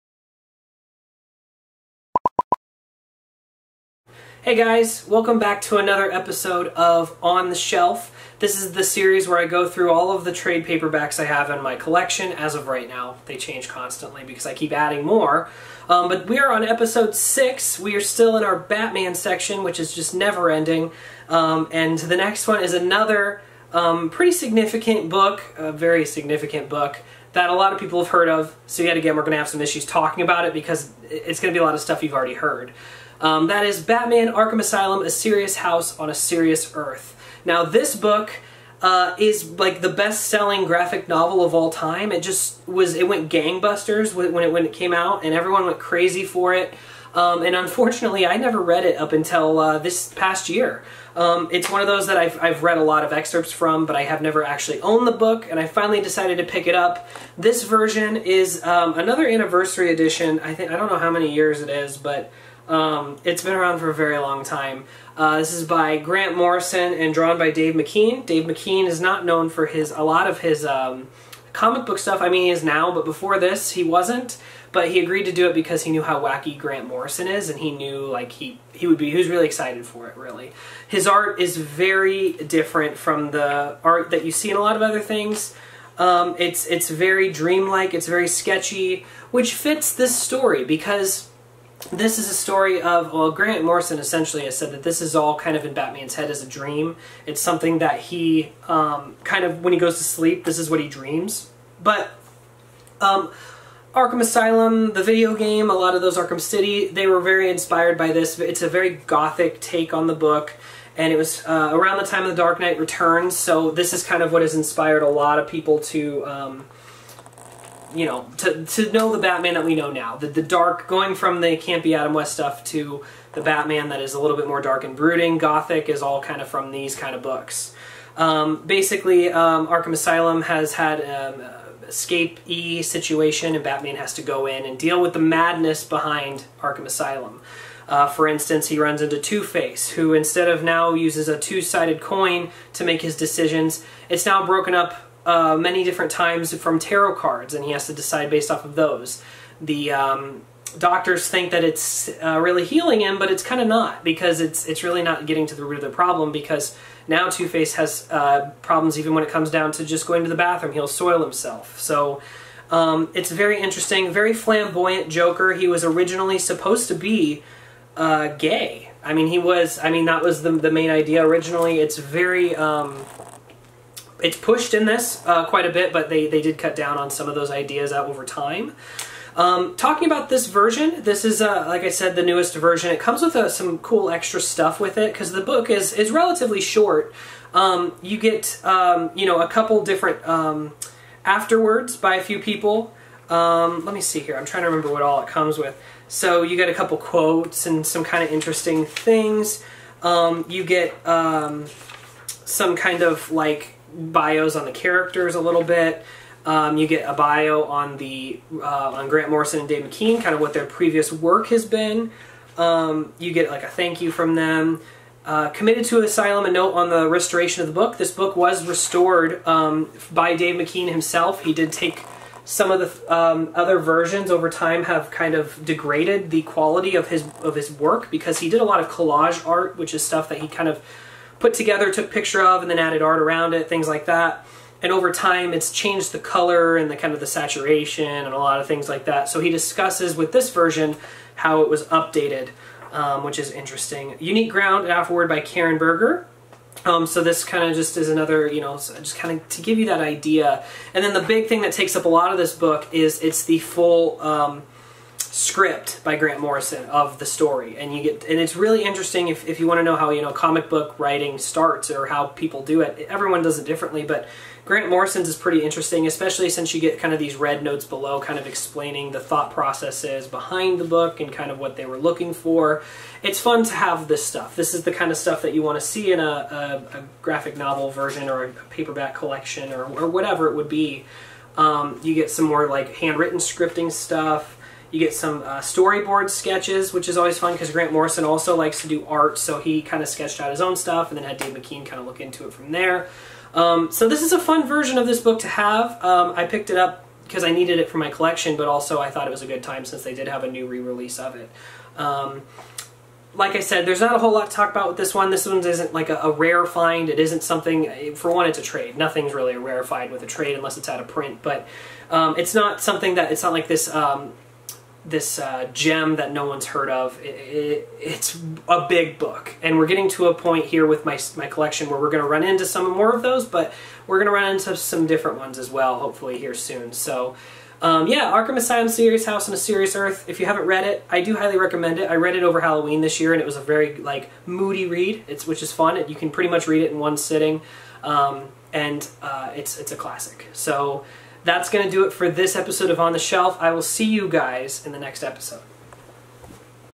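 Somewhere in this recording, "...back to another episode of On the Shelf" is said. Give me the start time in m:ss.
0:05.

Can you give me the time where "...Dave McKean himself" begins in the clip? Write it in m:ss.
3:40.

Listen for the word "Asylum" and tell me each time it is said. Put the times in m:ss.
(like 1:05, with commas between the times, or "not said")
0:34, 1:44, 2:09, 2:16, 3:36, 5:28.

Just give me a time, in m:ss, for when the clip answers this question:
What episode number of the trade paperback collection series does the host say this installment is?
0:16.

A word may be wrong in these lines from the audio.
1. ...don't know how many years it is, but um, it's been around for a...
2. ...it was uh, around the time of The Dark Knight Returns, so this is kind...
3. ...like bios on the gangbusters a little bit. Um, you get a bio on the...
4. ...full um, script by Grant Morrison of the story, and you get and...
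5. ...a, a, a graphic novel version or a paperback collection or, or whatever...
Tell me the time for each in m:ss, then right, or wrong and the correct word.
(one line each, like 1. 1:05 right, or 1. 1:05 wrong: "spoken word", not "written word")
1. 1:00 right
2. 1:51 right
3. 3:23 wrong: "characters", not "gangbusters"
4. 4:13 right
5. 4:36 right.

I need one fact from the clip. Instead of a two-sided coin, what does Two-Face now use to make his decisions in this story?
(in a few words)
Tarot cards.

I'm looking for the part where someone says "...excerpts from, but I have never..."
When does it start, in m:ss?
0:53.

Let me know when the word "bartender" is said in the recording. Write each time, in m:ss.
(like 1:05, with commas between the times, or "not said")
not said.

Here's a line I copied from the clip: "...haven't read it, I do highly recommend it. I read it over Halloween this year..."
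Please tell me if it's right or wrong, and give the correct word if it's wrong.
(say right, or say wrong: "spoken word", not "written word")
right.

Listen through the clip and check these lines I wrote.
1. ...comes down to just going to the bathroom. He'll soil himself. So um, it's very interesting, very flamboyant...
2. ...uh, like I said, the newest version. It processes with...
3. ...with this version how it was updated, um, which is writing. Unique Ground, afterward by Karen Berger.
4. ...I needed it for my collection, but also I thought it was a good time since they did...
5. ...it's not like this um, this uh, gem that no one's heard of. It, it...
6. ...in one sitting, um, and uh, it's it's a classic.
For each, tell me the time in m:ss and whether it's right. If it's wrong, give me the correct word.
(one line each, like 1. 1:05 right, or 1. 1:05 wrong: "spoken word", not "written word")
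1. 2:39 right
2. 3:01 wrong: "comes", not "processes"
3. 4:00 wrong: "interesting", not "writing"
4. 4:57 right
5. 5:13 right
6. 5:36 right.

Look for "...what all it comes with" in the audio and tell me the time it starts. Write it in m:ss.
3:14.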